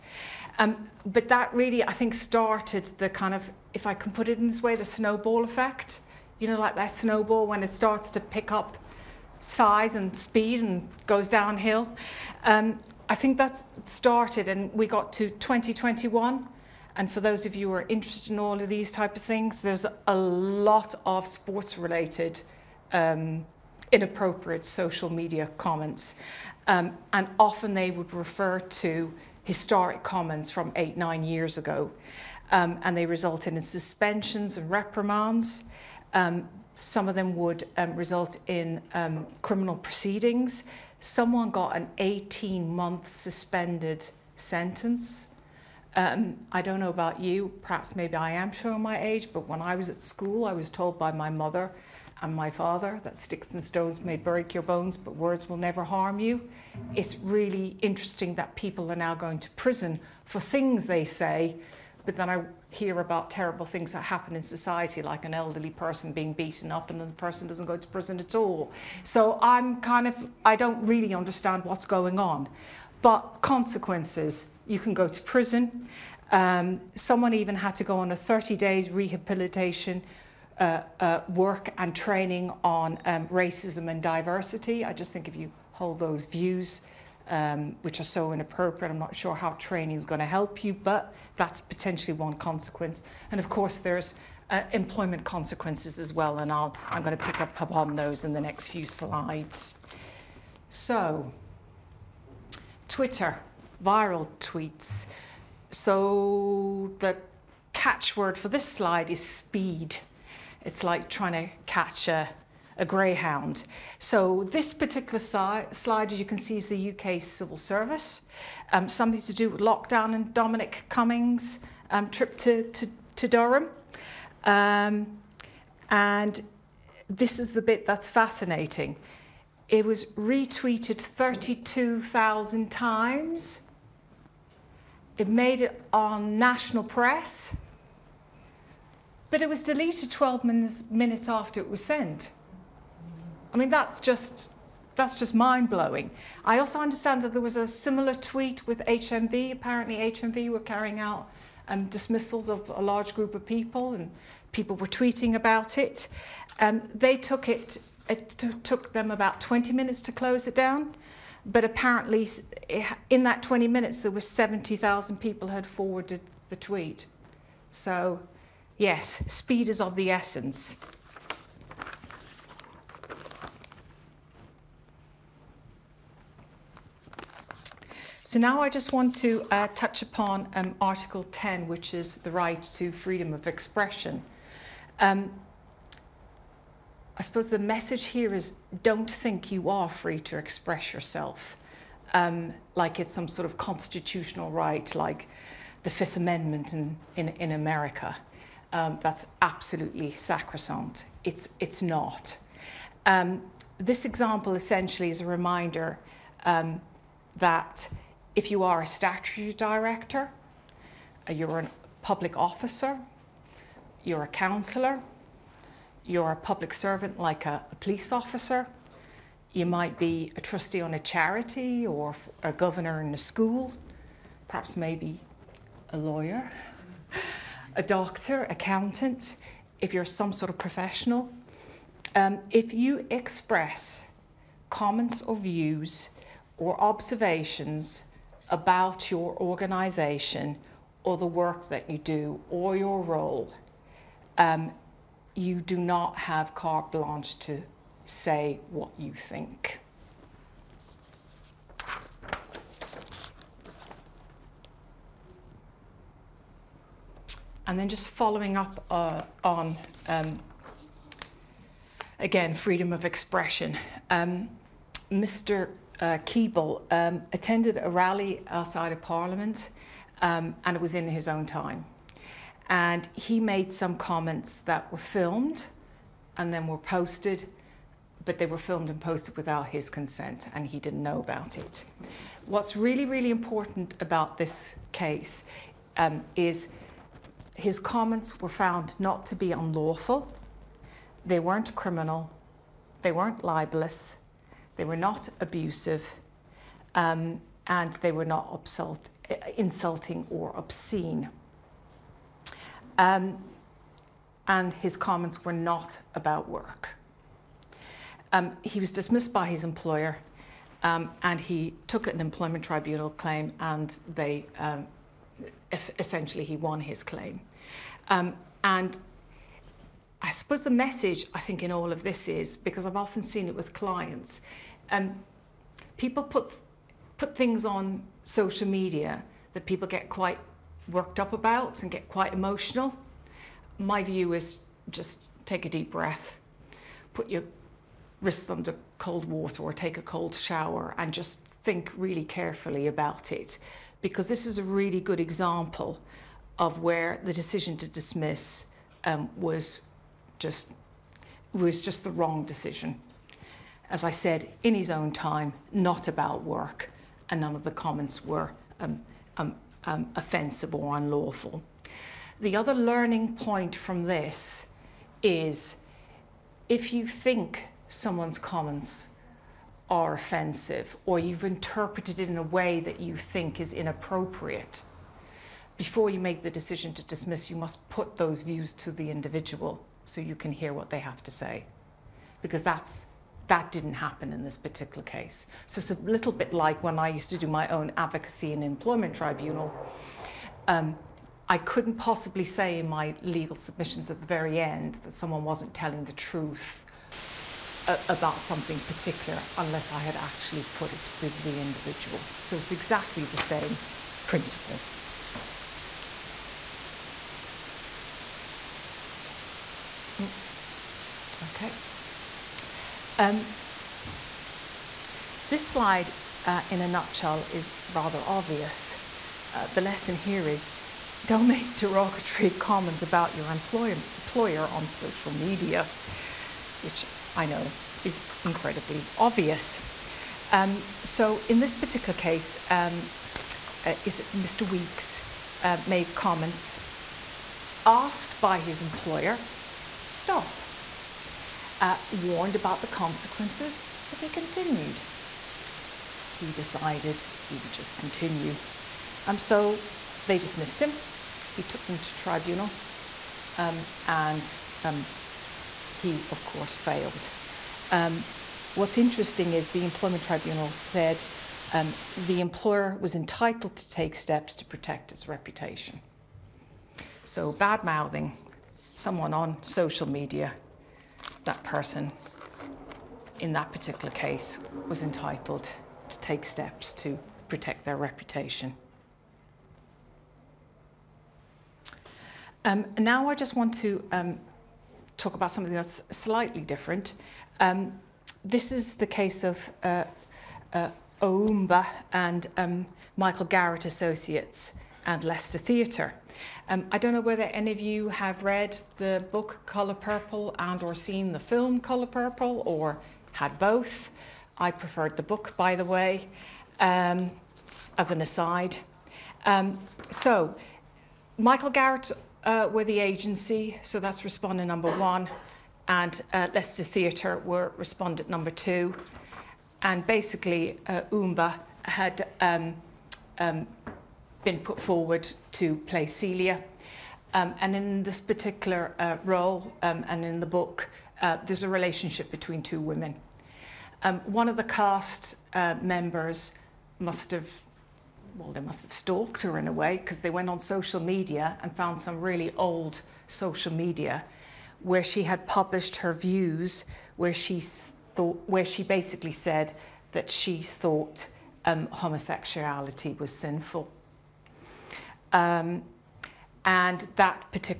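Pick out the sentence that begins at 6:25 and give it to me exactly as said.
So it's a little bit like when I used to do my own advocacy and employment tribunal.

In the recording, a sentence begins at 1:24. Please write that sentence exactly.
I just think if you hold those views um, which are so inappropriate.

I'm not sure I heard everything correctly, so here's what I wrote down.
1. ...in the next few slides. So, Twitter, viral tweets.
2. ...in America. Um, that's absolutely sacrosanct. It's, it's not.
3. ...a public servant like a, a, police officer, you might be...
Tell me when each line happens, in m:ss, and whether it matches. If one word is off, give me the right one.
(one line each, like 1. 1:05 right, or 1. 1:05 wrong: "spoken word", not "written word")
1. 1:38 right
2. 3:17 right
3. 3:36 right.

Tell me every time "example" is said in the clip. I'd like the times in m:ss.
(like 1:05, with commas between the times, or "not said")
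3:24, 5:45.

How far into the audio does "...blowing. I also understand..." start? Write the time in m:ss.
2:25.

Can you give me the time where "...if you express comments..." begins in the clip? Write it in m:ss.
3:52.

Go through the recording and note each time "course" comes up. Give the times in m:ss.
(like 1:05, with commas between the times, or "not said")
1:33, 7:36.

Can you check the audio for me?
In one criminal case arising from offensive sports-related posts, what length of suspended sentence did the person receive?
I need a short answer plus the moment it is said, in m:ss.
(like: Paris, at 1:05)
18 months, at 0:41.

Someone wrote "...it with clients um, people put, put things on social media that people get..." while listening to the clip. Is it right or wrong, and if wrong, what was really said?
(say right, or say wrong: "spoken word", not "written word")
right.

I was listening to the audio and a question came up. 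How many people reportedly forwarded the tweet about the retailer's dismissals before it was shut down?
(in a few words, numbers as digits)
70,000.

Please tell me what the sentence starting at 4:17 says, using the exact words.
And then just following up uh, on, um, again, freedom of expression.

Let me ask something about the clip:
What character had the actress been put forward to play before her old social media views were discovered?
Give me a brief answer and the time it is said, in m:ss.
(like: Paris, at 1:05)
Celie, at 8:46.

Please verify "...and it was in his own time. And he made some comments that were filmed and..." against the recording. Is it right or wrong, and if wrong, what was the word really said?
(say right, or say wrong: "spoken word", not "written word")
right.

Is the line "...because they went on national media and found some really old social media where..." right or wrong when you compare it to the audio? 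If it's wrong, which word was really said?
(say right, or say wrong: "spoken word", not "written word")
wrong: "social", not "national".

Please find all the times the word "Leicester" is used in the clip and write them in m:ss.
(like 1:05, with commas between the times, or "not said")
8:15, 8:36.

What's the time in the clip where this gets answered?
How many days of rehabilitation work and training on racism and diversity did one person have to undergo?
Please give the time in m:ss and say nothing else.
1:18.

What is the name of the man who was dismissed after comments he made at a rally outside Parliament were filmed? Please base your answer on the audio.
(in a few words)
Keeble.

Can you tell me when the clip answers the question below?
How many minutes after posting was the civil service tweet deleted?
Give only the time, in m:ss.
2:20.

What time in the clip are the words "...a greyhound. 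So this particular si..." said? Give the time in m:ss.
1:52.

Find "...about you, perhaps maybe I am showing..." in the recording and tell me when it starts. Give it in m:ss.
0:46.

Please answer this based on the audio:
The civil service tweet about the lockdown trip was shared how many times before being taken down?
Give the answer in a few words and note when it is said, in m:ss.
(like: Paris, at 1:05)
32,000, at 2:10.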